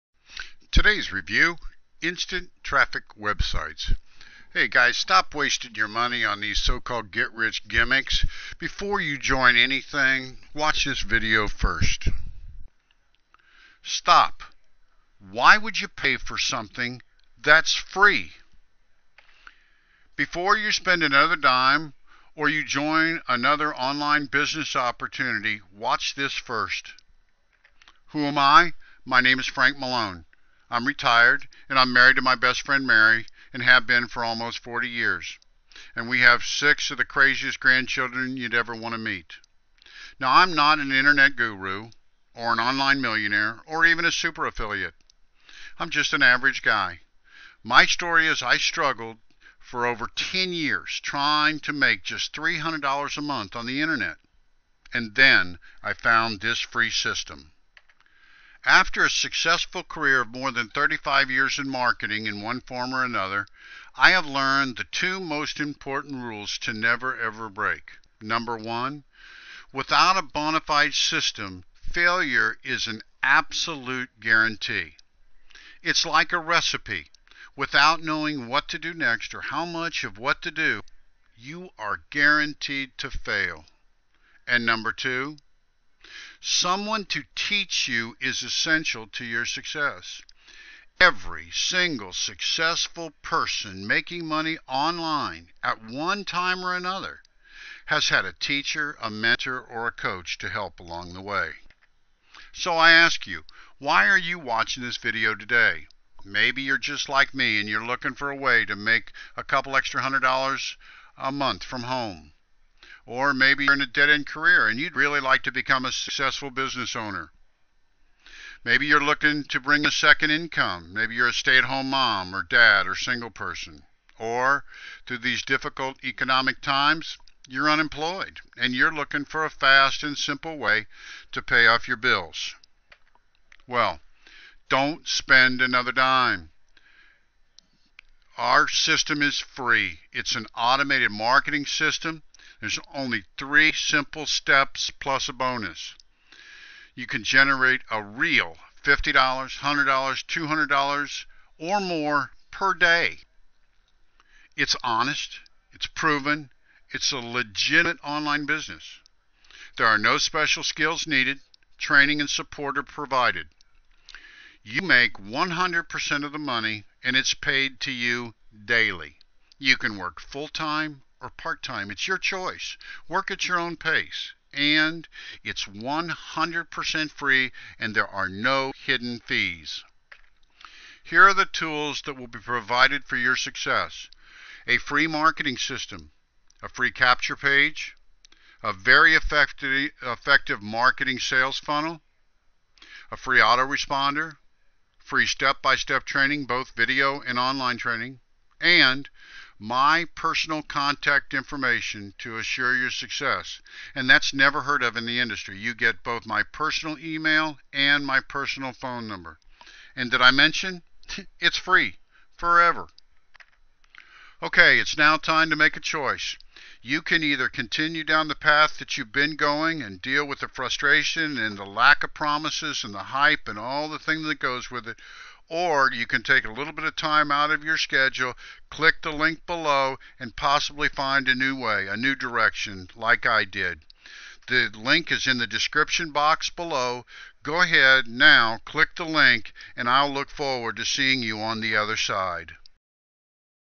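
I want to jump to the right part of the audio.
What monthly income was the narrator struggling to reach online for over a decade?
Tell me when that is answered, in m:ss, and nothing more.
0:52.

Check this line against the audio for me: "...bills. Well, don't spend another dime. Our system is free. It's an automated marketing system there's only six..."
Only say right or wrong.
wrong.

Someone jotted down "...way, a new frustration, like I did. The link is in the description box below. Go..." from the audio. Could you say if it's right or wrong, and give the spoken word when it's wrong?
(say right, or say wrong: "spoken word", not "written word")
wrong: "direction", not "frustration".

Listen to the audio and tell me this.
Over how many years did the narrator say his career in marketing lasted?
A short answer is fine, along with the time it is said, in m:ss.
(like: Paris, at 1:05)
35, at 1:00.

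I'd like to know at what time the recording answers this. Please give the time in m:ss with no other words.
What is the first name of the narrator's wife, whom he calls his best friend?
0:32.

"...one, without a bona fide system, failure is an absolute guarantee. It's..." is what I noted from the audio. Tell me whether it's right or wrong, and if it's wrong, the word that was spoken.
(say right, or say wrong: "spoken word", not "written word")
right.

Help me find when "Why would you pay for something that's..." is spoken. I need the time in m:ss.
0:15.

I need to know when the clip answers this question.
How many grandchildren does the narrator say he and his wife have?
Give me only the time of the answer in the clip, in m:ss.
0:36.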